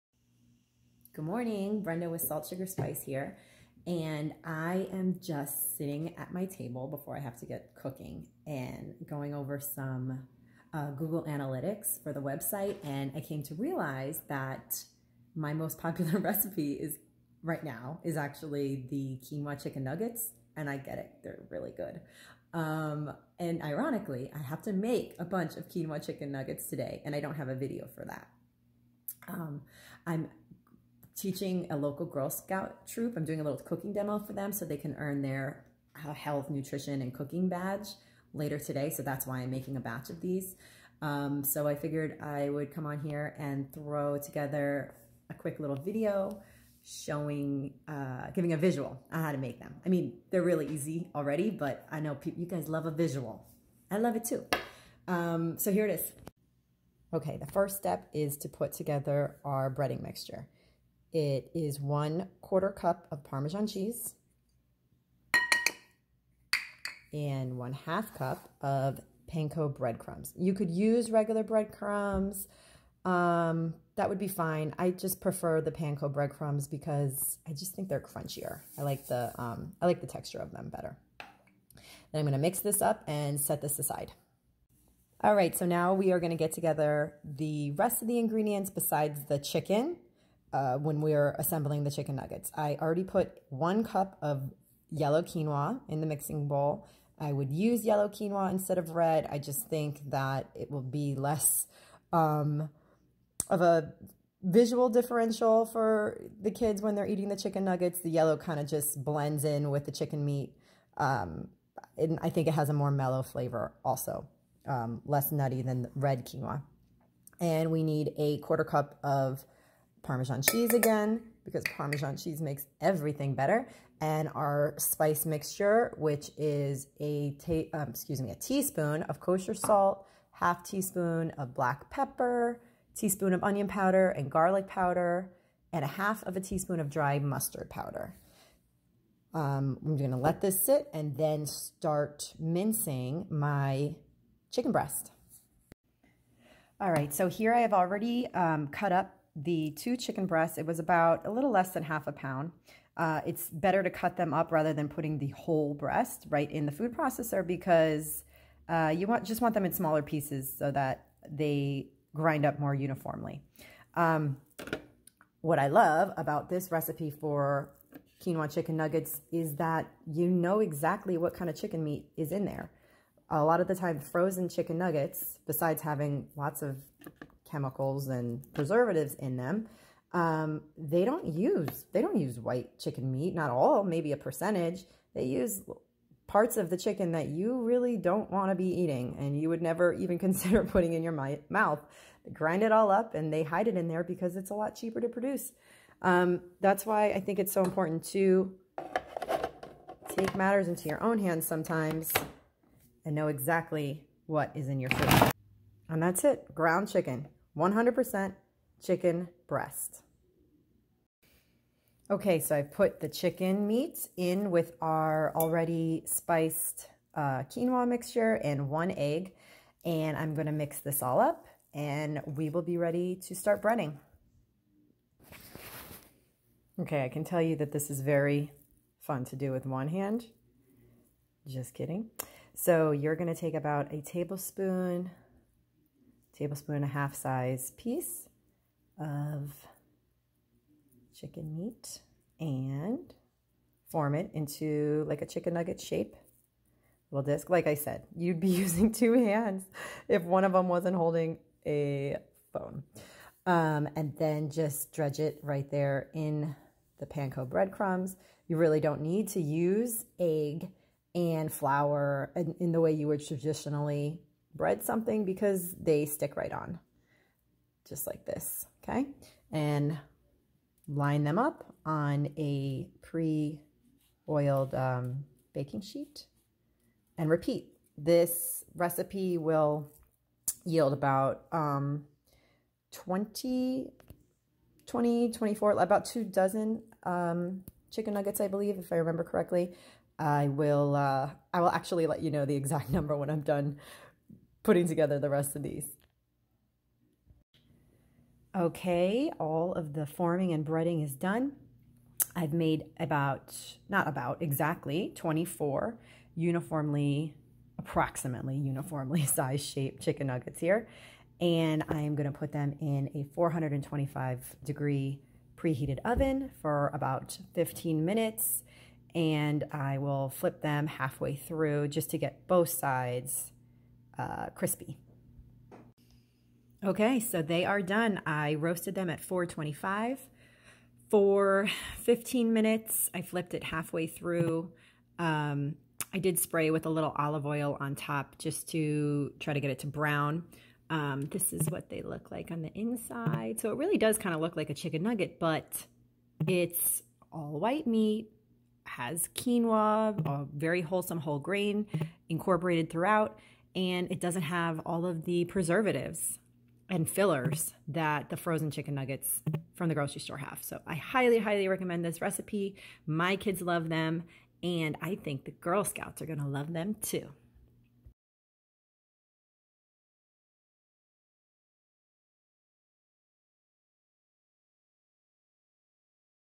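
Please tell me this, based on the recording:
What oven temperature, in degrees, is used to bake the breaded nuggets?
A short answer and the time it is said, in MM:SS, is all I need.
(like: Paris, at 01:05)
425, at 05:13.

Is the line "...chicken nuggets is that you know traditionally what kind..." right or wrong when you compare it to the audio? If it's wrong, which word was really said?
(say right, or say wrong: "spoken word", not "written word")
wrong: "exactly", not "traditionally".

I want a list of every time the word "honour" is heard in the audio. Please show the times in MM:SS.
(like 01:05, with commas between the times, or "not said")
not said.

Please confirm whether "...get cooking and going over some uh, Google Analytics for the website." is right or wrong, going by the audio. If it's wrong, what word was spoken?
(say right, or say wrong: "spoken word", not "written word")
right.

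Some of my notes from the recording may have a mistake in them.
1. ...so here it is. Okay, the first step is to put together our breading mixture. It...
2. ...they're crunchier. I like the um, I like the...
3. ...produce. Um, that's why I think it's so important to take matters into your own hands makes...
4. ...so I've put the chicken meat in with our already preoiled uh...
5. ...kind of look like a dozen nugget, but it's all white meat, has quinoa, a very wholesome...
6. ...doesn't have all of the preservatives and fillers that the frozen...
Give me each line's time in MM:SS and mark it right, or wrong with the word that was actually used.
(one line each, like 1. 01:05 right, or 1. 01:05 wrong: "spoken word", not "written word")
1. 00:55 right
2. 01:17 right
3. 03:15 wrong: "sometimes", not "makes"
4. 03:32 wrong: "spiced", not "preoiled"
5. 05:44 wrong: "chicken", not "dozen"
6. 05:54 right.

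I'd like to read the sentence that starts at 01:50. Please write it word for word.
Um, and I think it has a more mellow flavor also, um, less nutty than red quinoa.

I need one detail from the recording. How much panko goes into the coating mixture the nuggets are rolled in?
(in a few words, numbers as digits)
1/2 cup.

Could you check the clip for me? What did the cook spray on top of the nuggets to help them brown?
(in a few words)
olive oil.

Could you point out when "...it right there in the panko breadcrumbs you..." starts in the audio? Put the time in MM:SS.
04:15.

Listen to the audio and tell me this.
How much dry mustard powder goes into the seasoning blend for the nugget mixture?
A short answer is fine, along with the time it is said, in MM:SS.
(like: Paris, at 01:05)
1/2 teaspoon, at 02:15.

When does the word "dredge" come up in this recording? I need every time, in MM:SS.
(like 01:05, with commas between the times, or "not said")
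04:14.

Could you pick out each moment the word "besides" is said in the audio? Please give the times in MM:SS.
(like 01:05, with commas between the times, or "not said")
01:28, 02:55.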